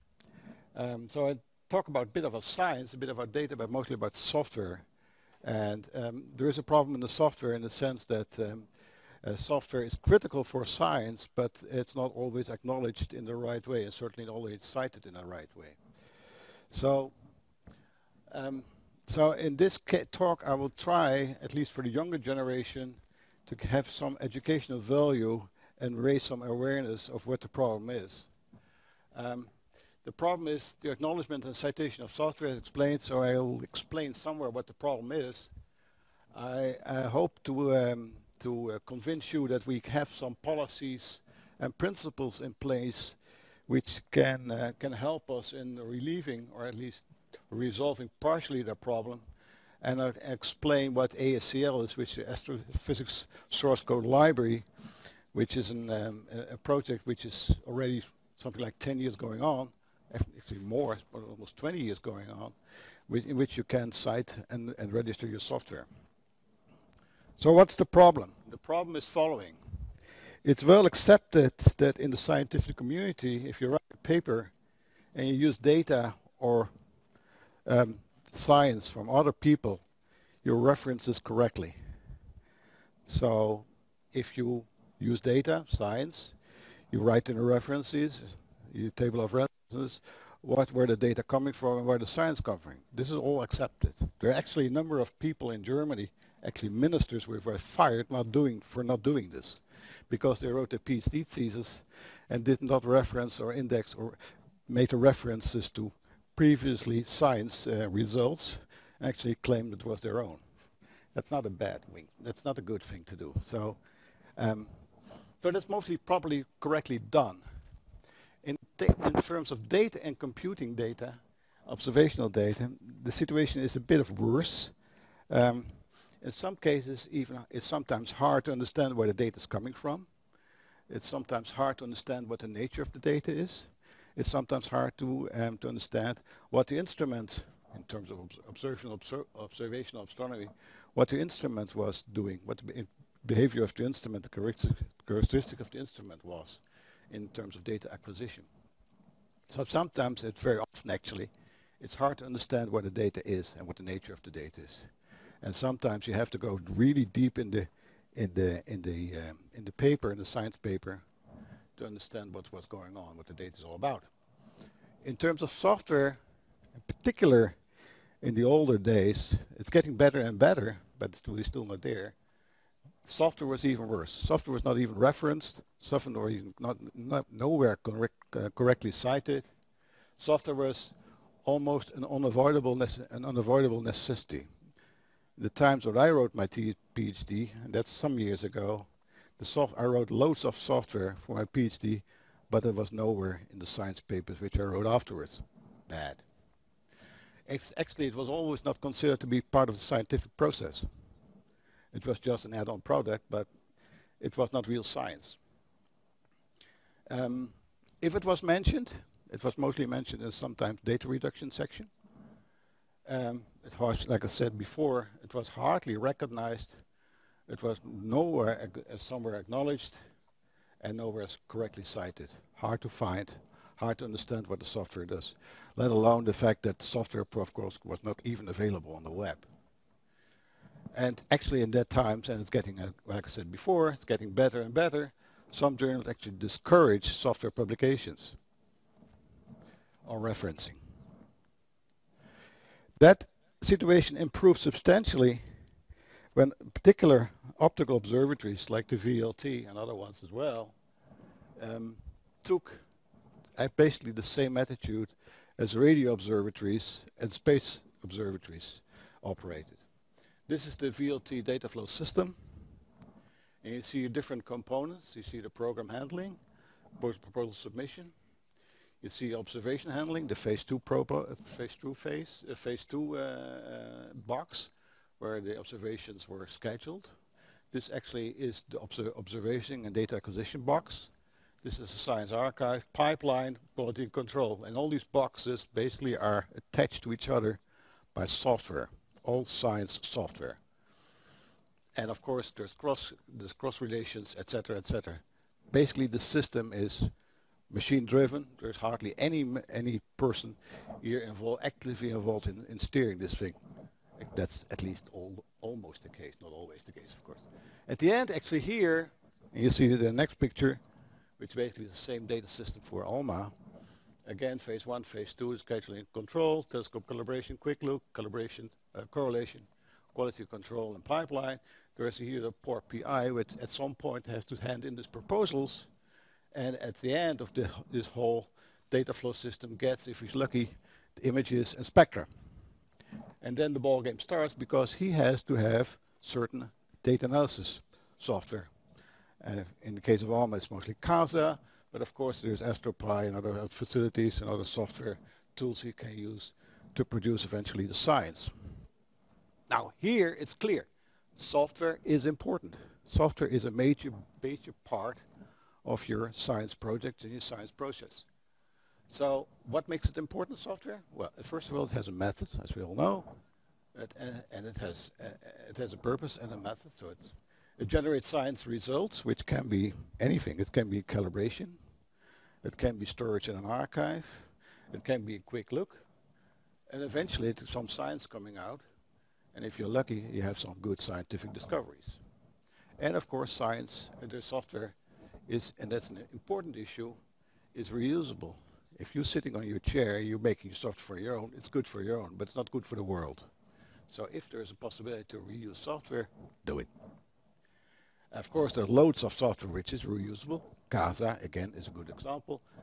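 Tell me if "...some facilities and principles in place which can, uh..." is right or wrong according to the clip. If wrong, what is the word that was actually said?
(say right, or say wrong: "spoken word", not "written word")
wrong: "policies", not "facilities".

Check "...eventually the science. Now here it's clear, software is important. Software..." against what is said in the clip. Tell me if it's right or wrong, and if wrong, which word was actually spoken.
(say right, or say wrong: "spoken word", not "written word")
right.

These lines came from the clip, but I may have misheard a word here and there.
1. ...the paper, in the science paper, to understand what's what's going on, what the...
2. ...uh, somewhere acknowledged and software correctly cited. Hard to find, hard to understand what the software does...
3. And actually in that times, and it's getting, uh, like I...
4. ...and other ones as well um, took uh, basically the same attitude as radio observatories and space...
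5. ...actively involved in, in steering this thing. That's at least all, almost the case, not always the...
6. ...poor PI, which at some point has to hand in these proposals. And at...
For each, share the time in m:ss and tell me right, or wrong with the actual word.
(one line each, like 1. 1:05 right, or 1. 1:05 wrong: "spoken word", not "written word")
1. 2:39 right
2. 3:38 wrong: "nowhere", not "software"
3. 3:50 right
4. 4:09 right
5. 5:01 right
6. 5:22 right.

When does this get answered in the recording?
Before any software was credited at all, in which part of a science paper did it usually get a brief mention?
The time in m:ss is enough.
3:30.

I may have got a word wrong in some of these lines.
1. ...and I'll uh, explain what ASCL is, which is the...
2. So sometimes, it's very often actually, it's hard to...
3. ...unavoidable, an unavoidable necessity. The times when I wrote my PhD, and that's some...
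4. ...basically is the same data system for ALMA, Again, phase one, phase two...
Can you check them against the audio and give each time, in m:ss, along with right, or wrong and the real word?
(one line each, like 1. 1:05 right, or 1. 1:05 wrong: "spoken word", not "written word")
1. 0:49 right
2. 2:29 right
3. 3:02 right
4. 5:11 right.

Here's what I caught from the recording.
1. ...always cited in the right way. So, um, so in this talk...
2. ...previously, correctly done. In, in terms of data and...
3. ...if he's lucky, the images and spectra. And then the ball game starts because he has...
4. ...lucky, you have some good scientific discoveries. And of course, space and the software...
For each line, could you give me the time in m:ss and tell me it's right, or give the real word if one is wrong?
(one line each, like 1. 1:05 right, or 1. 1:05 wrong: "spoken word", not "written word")
1. 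0:14 right
2. 1:55 wrong: "properly", not "previously"
3. 5:30 right
4. 6:19 wrong: "science", not "space".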